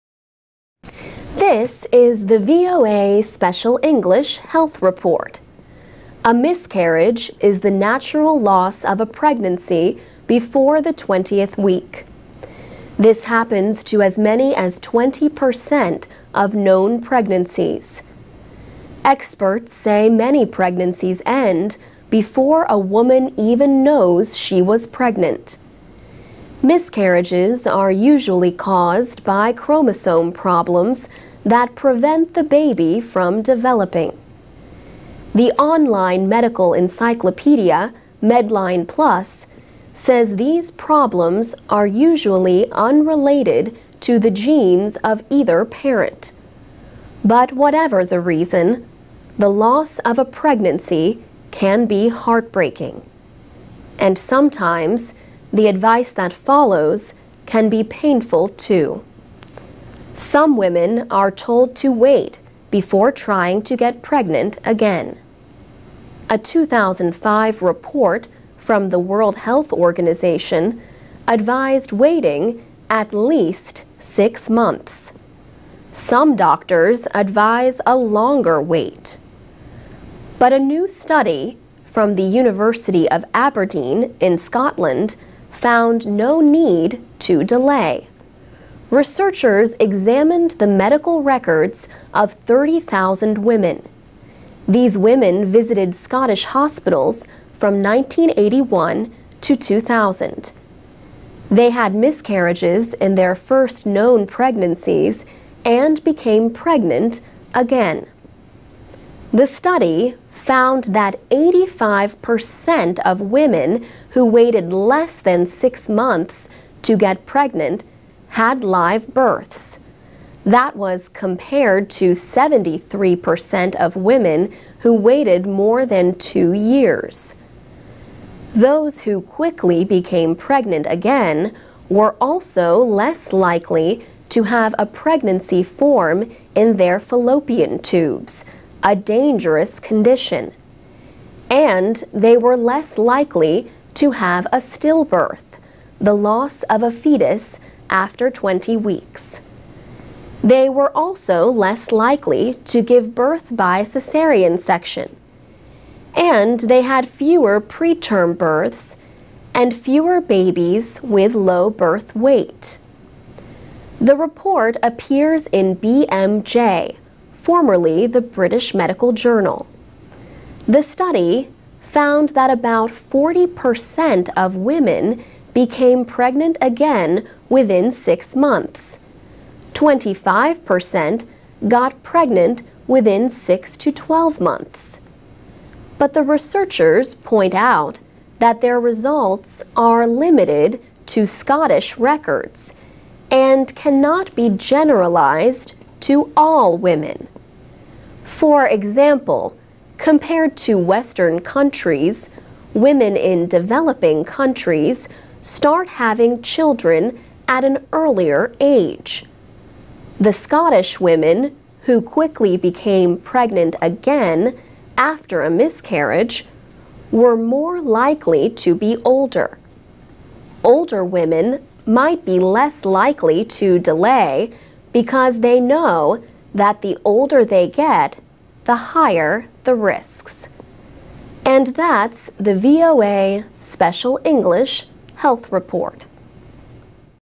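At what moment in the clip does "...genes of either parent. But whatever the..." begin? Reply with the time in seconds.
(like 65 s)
44 s.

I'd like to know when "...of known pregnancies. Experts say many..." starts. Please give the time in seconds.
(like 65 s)
16 s.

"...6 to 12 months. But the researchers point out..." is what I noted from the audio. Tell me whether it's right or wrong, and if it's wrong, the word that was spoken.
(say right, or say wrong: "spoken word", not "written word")
right.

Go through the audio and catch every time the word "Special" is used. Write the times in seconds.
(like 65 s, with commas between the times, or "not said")
3 s, 233 s.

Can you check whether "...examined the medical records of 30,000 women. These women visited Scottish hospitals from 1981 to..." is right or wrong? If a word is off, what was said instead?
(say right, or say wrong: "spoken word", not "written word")
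right.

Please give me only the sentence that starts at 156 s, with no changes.
And they had fewer preterm births and fewer babies with low birth weight.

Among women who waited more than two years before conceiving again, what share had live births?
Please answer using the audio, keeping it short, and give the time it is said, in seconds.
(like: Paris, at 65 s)
73%, at 122 s.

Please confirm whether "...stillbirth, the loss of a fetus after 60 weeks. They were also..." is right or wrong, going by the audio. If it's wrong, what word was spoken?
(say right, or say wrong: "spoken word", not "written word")
wrong: "20", not "60".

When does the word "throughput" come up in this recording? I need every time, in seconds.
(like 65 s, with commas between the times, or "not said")
not said.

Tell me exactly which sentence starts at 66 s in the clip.
A 2005 report from the World Health Organization advised waiting at least six months.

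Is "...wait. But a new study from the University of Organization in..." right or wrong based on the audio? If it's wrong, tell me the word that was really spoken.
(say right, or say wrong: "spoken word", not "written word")
wrong: "Aberdeen", not "Organization".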